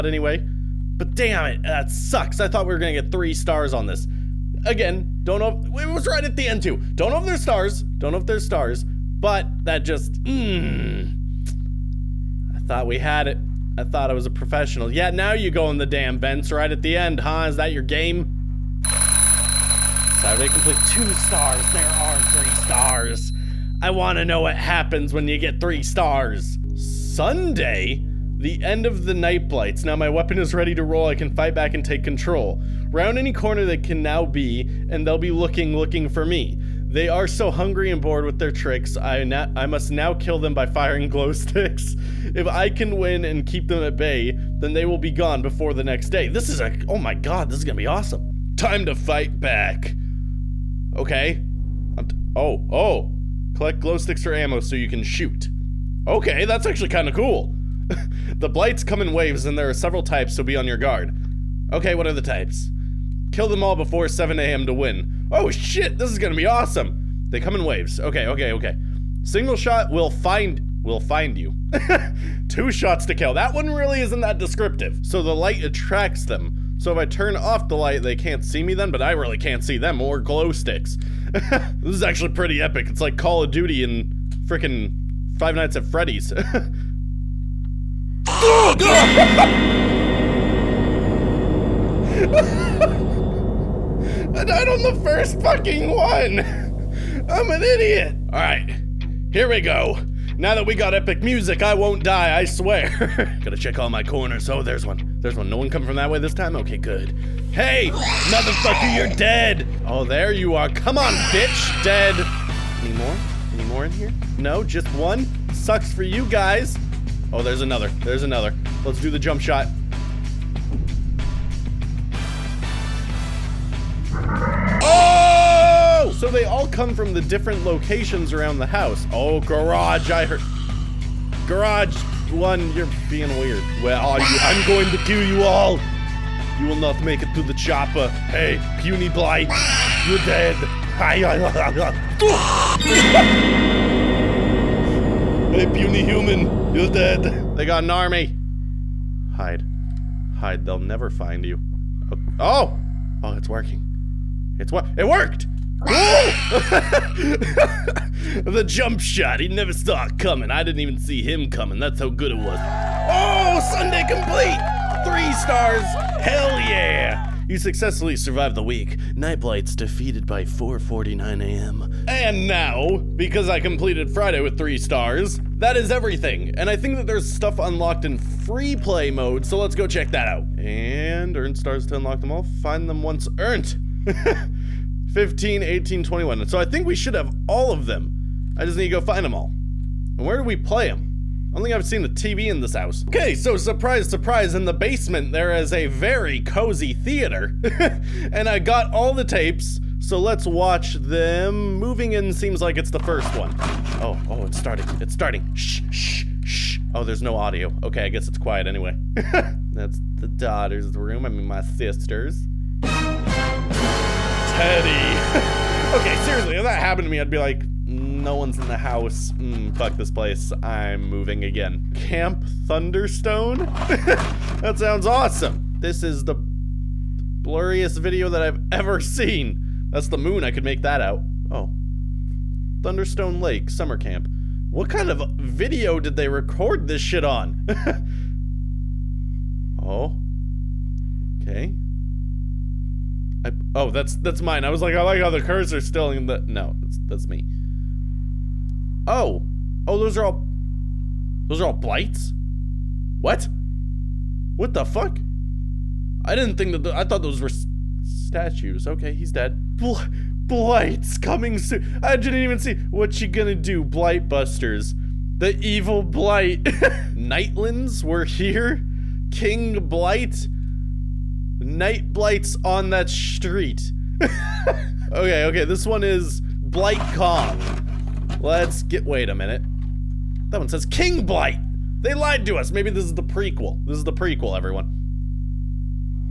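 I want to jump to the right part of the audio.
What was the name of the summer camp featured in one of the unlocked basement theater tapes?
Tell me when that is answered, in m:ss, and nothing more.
3:41.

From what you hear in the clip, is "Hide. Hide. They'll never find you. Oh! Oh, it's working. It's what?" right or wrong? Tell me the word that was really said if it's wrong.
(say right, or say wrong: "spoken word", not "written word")
right.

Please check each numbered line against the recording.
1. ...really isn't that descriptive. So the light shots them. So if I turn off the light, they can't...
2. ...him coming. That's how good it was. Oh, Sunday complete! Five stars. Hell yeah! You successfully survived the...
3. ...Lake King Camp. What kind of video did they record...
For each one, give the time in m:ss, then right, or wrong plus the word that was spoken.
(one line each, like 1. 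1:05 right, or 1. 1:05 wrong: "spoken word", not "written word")
1. 1:13 wrong: "attracts", not "shots"
2. 2:41 wrong: "Three", not "Five"
3. 3:53 wrong: "Summer", not "King".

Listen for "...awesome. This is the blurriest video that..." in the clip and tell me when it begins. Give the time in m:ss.
3:45.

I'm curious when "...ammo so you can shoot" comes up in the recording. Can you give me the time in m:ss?
0:54.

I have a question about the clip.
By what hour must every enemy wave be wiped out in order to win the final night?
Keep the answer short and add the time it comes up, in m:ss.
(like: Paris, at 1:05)
7 a.m., at 1:04.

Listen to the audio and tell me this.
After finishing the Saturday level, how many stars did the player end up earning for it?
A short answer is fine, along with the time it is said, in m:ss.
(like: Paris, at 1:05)
2, at 0:20.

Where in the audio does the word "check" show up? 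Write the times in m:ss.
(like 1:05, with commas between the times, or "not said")
1:43, 2:59.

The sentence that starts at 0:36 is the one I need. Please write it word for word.
They are so hungry and bored with their tricks.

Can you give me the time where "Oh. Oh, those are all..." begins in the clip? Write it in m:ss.
4:09.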